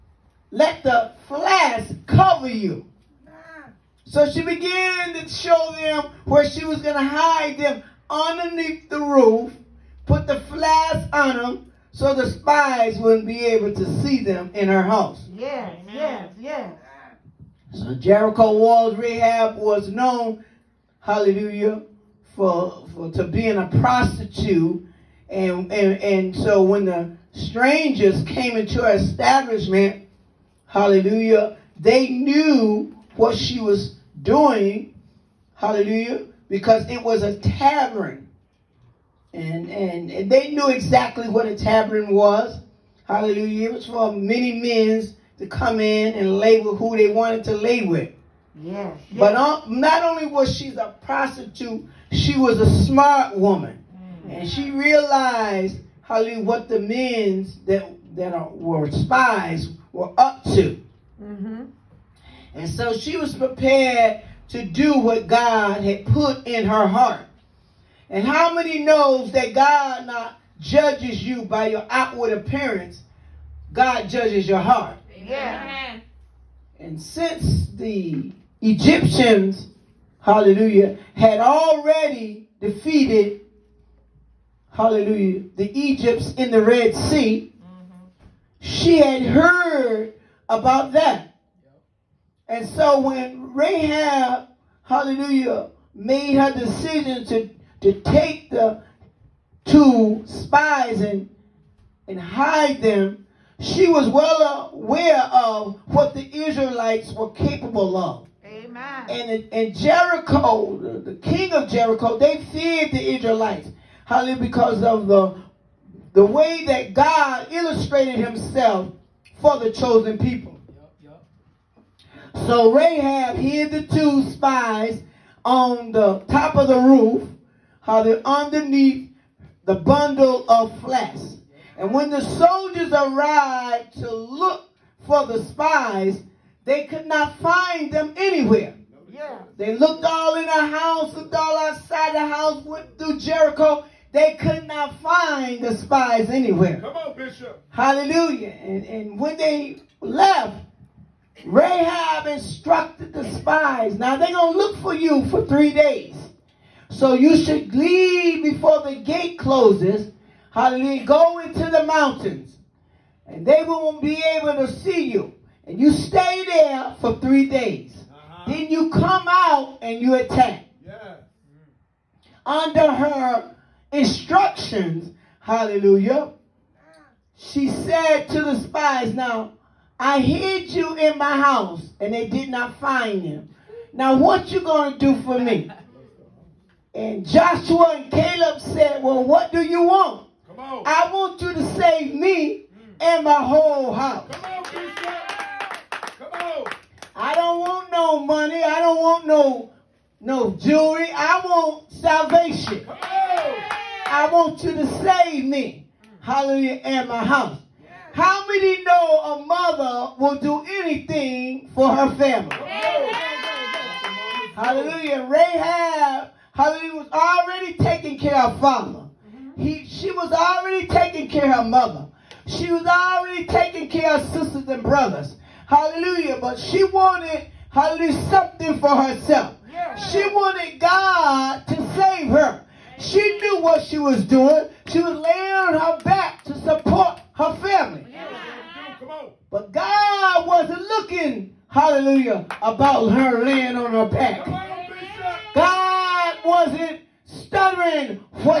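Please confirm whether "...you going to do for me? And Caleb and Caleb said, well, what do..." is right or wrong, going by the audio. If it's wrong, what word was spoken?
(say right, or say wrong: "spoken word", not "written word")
wrong: "Joshua", not "Caleb".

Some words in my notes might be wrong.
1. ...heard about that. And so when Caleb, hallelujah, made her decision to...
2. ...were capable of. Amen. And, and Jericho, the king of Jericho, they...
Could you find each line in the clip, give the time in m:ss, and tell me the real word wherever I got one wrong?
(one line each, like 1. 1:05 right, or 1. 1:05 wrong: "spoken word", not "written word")
1. 1:29 wrong: "Rahab", not "Caleb"
2. 1:47 right.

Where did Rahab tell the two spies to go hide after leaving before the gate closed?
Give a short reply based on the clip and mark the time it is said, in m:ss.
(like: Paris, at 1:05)
the mountains, at 2:41.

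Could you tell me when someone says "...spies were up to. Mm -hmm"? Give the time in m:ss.
0:58.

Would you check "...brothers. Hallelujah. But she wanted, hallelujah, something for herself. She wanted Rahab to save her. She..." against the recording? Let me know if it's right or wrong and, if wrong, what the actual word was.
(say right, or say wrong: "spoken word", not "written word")
wrong: "God", not "Rahab".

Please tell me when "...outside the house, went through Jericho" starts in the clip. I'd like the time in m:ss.
2:21.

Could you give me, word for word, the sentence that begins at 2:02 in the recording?
So Rahab hid the two spies on the top of the roof how they're underneath the bundle of flesh.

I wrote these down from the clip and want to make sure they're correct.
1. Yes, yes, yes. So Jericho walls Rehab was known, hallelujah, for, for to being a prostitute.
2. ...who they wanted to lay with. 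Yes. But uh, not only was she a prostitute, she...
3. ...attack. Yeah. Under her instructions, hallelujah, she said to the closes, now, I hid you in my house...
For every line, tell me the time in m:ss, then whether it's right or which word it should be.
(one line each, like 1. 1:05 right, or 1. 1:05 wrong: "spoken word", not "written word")
1. 0:15 right
2. 0:46 right
3. 2:50 wrong: "spies", not "closes".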